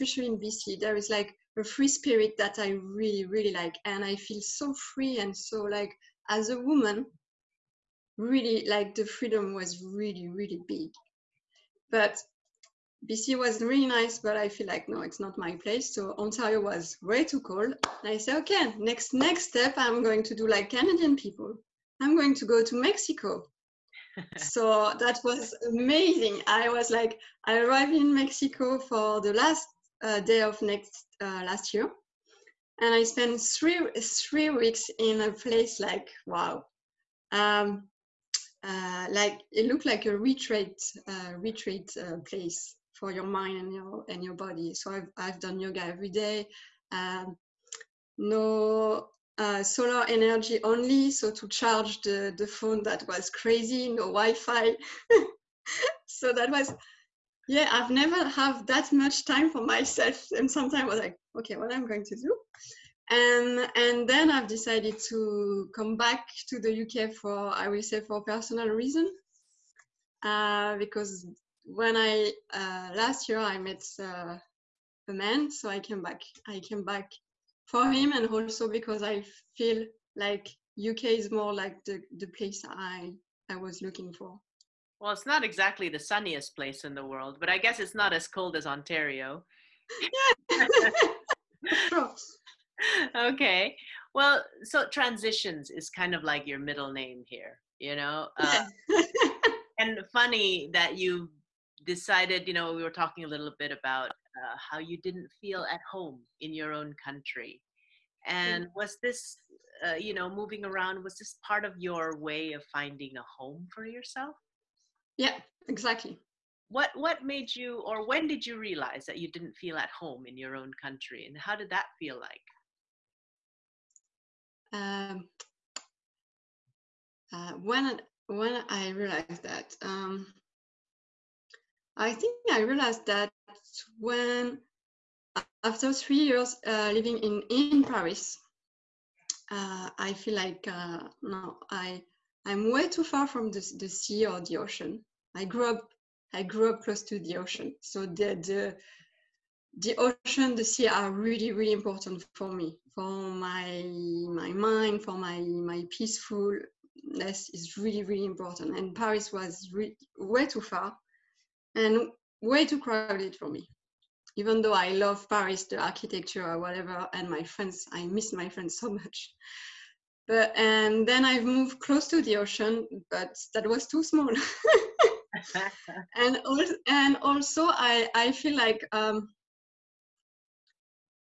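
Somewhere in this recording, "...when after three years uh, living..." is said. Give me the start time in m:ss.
2:13.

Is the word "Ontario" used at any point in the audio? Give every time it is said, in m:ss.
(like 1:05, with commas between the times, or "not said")
0:16, 1:28.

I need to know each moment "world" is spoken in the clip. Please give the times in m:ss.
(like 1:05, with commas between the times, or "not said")
1:27.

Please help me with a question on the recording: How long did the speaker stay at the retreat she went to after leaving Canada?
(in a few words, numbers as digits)
3 weeks.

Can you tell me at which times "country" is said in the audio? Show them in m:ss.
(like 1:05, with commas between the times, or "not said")
1:47, 2:00.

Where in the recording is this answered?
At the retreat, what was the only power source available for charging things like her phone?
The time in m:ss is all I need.
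0:49.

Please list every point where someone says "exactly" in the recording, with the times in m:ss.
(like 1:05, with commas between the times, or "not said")
1:25, 1:55.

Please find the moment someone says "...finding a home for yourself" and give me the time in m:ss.
1:52.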